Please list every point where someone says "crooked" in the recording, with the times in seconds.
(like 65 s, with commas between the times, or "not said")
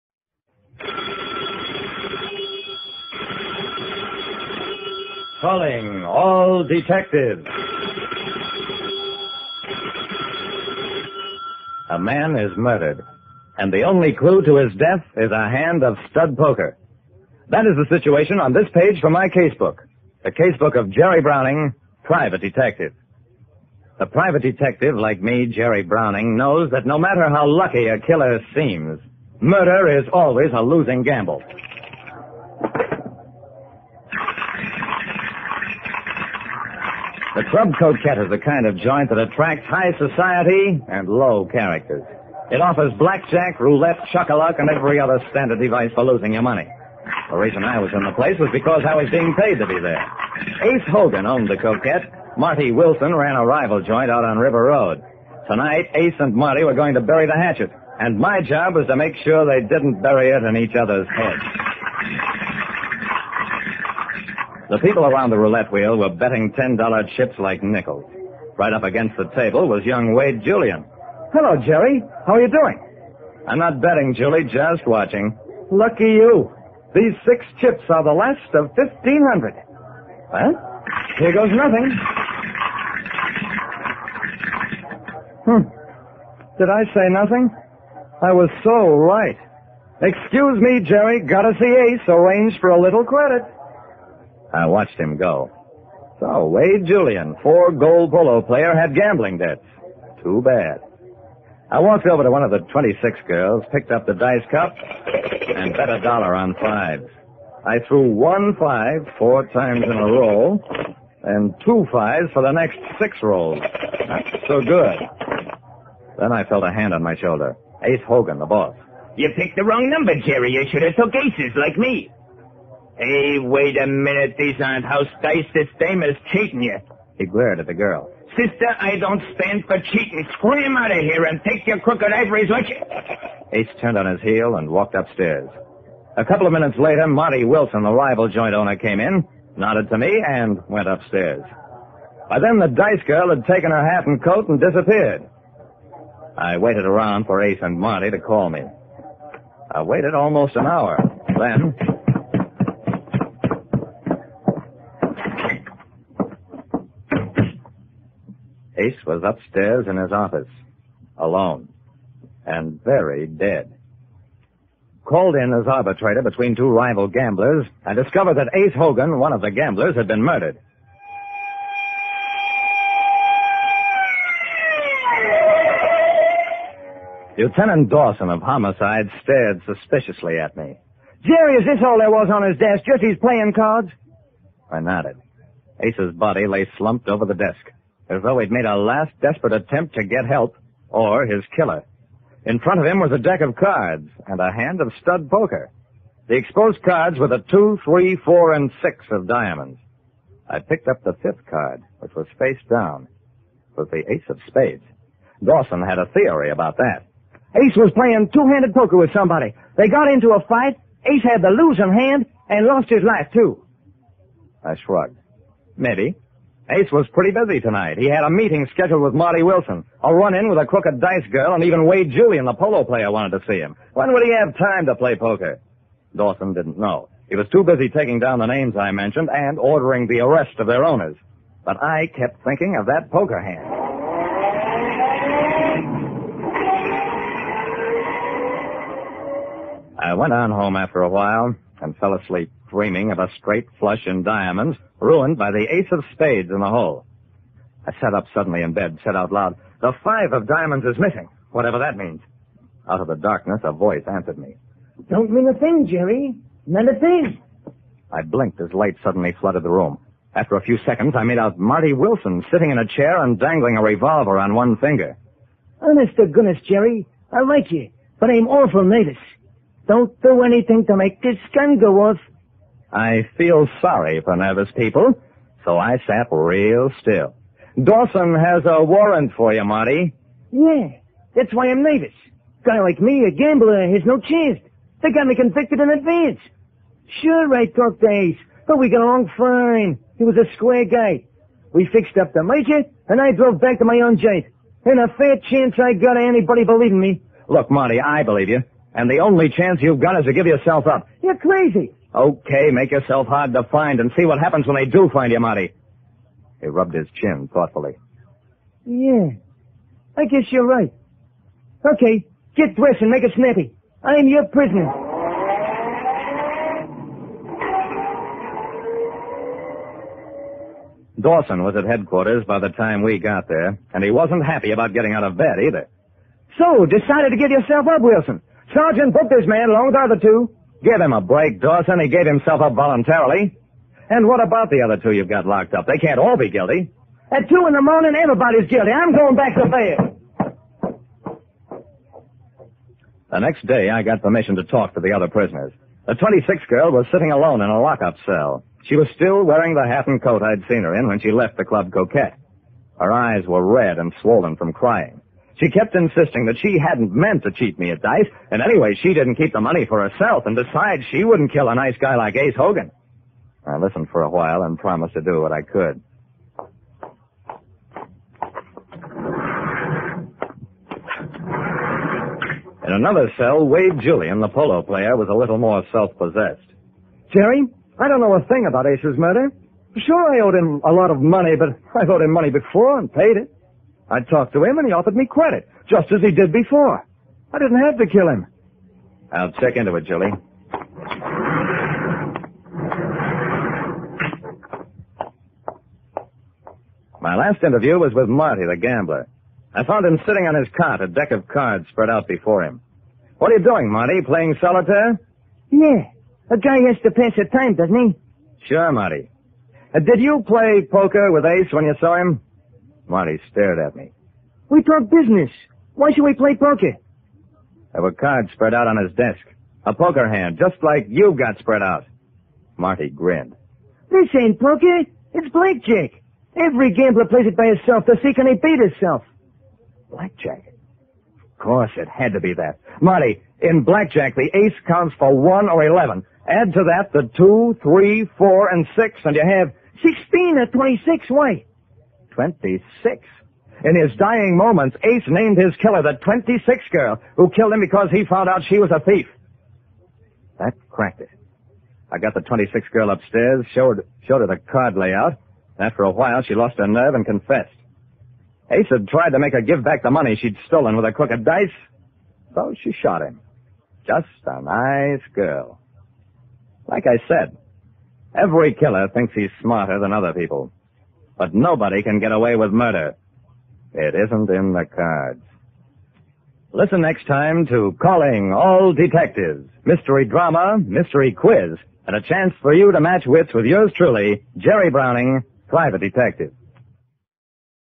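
131 s, 220 s, 461 s.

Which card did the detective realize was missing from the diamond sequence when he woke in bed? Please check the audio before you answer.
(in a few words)
five of diamonds.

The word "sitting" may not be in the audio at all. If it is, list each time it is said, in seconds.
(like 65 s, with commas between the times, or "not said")
262 s, 347 s, 400 s.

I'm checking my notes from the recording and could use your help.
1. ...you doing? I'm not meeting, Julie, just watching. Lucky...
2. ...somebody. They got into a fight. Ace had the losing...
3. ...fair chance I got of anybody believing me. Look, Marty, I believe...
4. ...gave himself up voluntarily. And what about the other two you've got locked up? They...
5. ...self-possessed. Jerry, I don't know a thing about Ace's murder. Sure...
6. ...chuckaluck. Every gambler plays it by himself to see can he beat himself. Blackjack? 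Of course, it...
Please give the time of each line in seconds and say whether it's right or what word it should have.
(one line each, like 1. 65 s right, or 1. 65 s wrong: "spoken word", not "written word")
1. 72 s wrong: "betting", not "meeting"
2. 209 s right
3. 295 s right
4. 332 s right
5. 375 s right
6. 425 s wrong: "blackjack", not "chuckaluck".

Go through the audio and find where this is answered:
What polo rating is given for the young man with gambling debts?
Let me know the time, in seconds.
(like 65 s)
97 s.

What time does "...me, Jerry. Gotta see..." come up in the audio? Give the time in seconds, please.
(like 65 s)
90 s.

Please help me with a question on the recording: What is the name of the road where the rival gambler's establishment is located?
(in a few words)
River Road.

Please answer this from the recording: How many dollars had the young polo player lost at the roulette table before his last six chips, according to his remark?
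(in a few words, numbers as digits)
1,500.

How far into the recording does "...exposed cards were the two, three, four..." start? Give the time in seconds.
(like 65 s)
196 s.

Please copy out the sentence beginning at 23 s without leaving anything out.
The private detective, like me, Jerry Browning, knows that no matter how lucky a killer seems, murder is always a losing gamble.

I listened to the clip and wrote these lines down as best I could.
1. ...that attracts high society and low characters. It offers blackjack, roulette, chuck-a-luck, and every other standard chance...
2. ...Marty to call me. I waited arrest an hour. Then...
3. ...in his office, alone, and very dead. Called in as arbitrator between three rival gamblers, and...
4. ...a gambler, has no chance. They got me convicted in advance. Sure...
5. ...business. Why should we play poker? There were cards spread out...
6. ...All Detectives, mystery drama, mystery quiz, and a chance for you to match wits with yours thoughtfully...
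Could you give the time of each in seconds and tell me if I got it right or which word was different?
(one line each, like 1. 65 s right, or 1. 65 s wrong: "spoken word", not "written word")
1. 39 s wrong: "device", not "chance"
2. 147 s wrong: "almost", not "arrest"
3. 159 s wrong: "two", not "three"
4. 283 s right
5. 415 s right
6. 478 s wrong: "truly", not "thoughtfully".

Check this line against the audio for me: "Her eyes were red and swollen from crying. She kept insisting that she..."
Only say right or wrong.
right.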